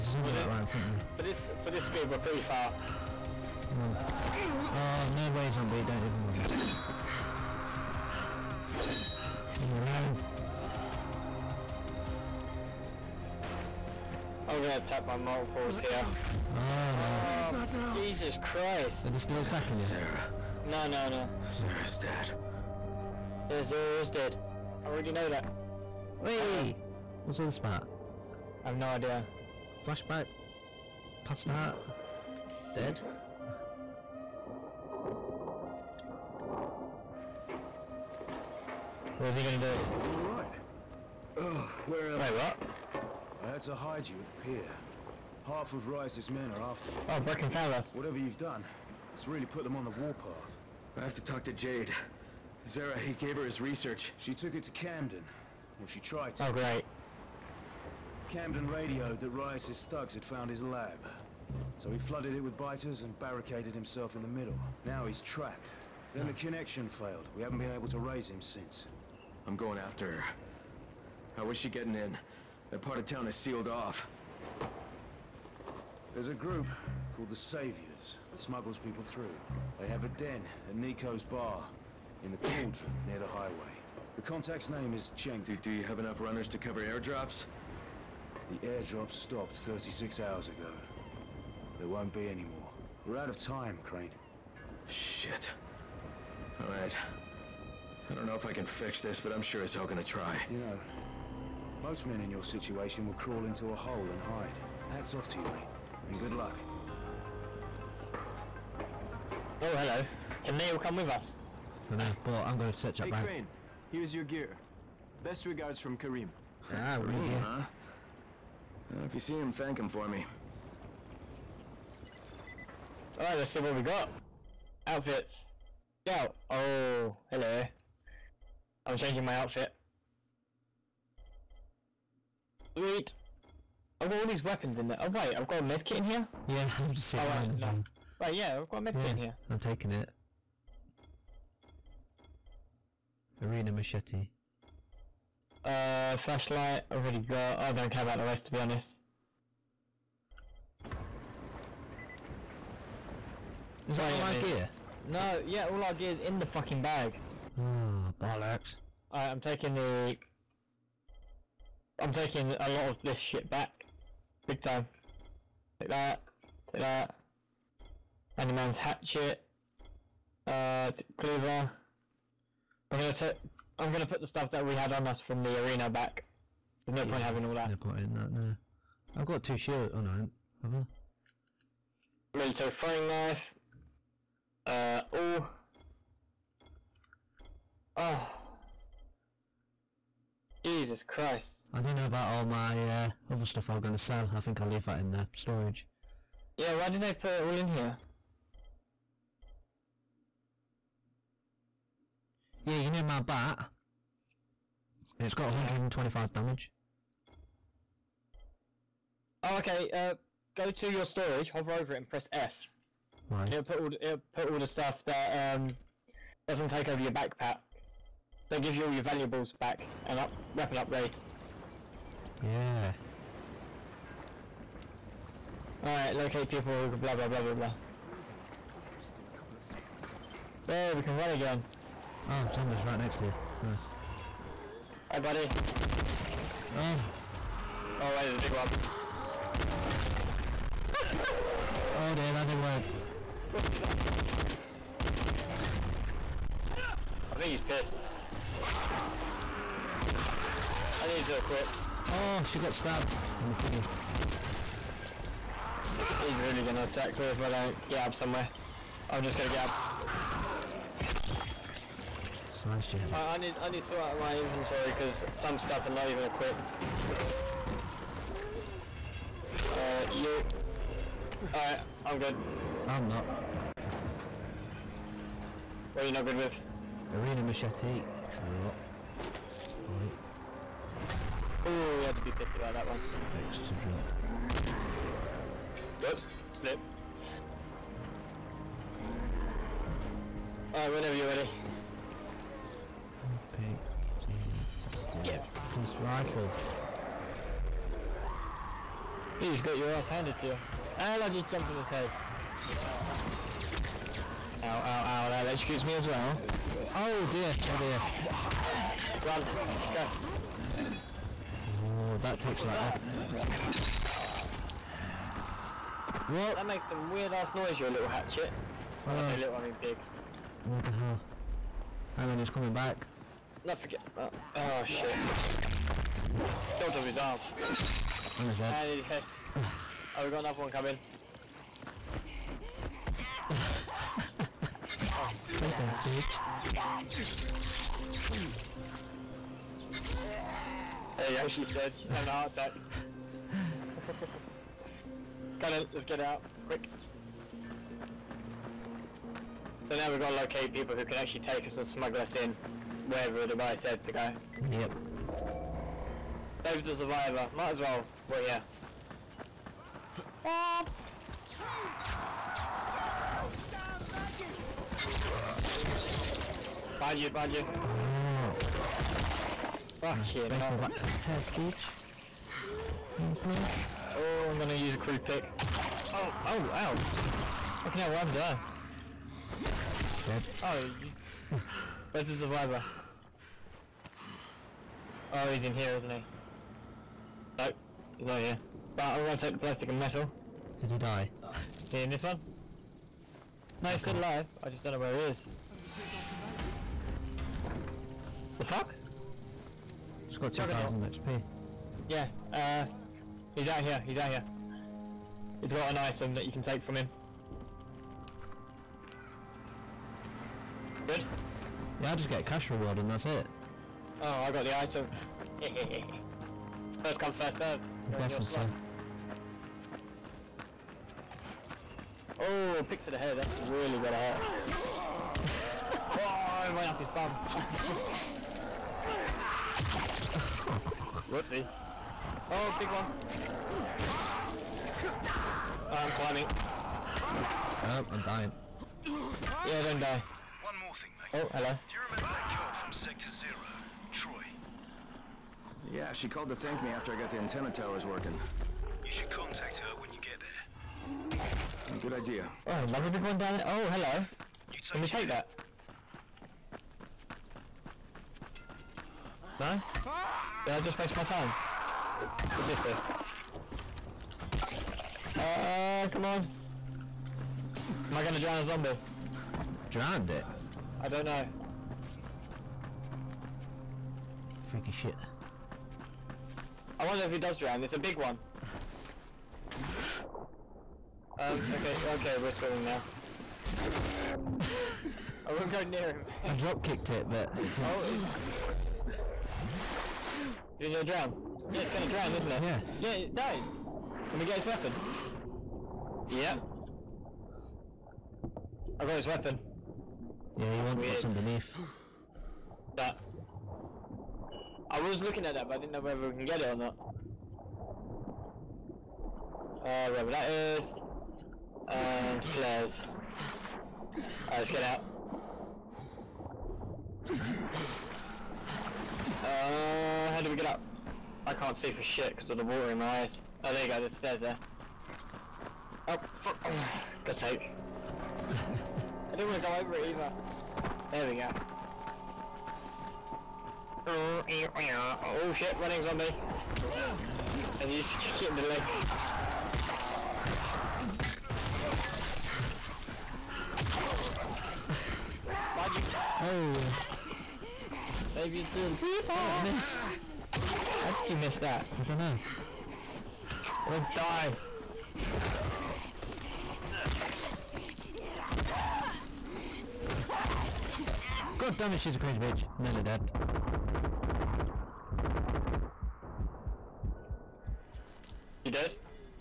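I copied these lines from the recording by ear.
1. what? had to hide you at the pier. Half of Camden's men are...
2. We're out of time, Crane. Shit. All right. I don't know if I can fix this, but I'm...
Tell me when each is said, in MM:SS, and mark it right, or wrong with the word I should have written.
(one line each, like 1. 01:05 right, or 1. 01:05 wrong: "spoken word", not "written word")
1. 00:42 wrong: "Rais", not "Camden"
2. 01:33 right.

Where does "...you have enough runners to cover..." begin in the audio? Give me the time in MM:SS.
01:25.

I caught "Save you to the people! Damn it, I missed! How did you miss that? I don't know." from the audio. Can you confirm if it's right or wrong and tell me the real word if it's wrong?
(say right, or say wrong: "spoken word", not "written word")
right.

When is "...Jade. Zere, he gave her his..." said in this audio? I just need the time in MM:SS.
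00:51.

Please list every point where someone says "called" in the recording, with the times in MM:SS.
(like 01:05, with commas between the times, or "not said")
01:17, 07:26.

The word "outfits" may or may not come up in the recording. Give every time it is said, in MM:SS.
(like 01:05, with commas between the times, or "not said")
02:04, 02:09.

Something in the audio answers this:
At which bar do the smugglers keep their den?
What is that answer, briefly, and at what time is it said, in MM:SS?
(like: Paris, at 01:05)
Nico's bar, at 01:20.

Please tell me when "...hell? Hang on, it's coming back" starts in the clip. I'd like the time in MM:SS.
05:20.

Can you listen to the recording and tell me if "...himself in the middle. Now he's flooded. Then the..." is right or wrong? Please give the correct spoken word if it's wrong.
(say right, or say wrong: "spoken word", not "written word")
wrong: "trapped", not "flooded".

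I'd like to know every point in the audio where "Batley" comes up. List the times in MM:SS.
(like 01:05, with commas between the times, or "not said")
not said.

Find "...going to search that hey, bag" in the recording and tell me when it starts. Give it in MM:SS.
01:52.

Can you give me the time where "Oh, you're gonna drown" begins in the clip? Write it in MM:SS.
08:07.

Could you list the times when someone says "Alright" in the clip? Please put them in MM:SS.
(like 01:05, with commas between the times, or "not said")
02:39, 03:45, 04:31, 04:50, 08:34.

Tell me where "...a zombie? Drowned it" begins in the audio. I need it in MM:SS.
07:48.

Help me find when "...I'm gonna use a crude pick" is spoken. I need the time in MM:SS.
06:14.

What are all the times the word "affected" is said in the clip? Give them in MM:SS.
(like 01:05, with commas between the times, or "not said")
not said.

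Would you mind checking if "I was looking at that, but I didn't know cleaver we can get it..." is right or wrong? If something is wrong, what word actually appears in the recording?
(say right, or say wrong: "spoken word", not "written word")
wrong: "whether", not "cleaver".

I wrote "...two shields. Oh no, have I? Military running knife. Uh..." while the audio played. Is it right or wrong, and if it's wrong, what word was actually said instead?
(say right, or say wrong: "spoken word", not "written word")
wrong: "throwing", not "running".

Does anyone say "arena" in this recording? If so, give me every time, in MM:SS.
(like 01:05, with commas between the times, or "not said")
02:23, 02:55, 04:37.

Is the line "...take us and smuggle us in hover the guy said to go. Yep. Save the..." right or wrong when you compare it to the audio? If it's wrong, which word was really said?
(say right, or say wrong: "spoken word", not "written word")
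wrong: "wherever", not "hover".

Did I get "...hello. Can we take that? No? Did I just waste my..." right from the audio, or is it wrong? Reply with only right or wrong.
right.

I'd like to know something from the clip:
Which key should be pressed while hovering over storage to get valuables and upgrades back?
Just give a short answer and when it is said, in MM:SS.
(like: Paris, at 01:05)
F, at 03:32.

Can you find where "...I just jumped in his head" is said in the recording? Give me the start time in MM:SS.
05:01.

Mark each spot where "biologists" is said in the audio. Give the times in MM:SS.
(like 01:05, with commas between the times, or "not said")
not said.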